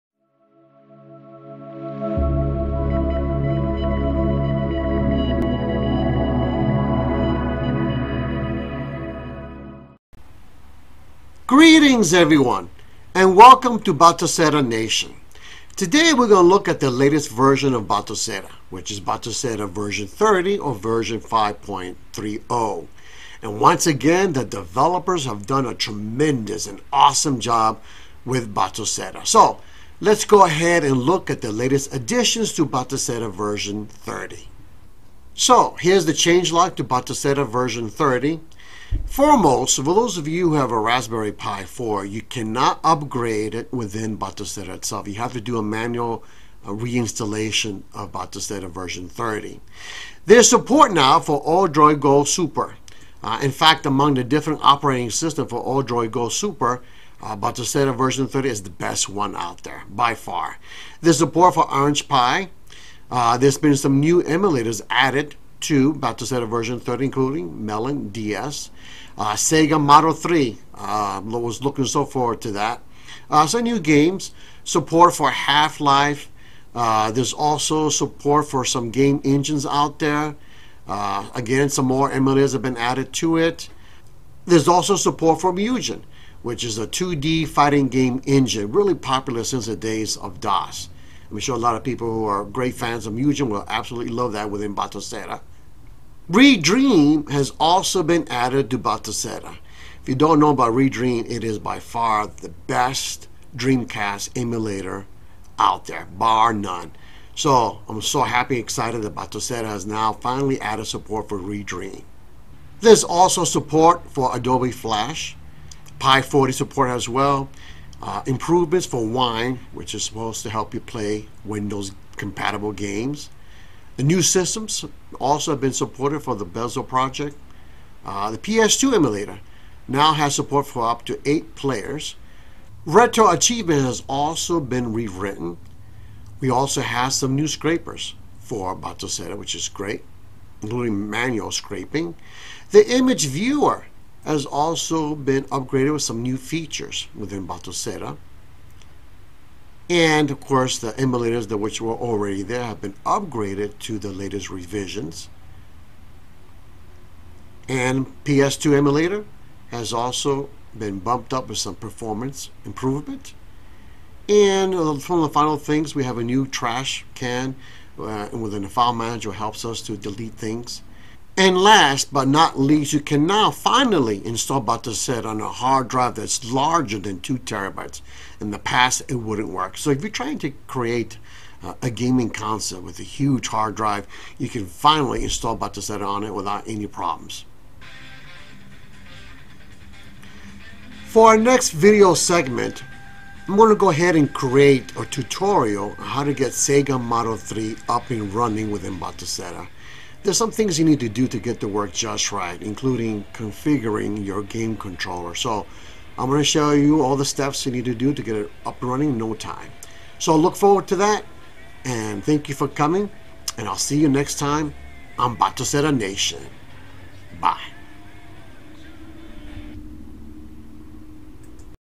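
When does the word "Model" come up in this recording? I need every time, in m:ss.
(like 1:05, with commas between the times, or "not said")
1:09, 3:17.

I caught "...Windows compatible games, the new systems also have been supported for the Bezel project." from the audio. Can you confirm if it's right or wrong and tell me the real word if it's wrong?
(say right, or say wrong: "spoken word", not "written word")
right.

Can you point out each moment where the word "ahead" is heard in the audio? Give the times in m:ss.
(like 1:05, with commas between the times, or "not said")
0:30, 3:13.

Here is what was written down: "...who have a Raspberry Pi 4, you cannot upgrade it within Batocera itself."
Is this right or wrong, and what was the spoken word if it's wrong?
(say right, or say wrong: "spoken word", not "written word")
right.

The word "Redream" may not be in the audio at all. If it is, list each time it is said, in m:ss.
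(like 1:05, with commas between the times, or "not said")
1:36, 1:40, 1:51.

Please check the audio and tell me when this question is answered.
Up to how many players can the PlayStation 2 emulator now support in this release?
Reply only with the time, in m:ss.
2:11.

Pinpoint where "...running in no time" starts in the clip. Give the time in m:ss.
3:28.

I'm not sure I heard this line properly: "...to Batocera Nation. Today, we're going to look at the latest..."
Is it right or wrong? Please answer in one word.
right.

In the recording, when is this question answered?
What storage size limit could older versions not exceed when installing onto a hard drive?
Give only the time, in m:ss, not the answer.
2:57.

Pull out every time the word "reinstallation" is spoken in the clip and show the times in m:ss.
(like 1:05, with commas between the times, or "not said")
0:46.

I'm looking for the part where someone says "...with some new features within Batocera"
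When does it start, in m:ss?
2:25.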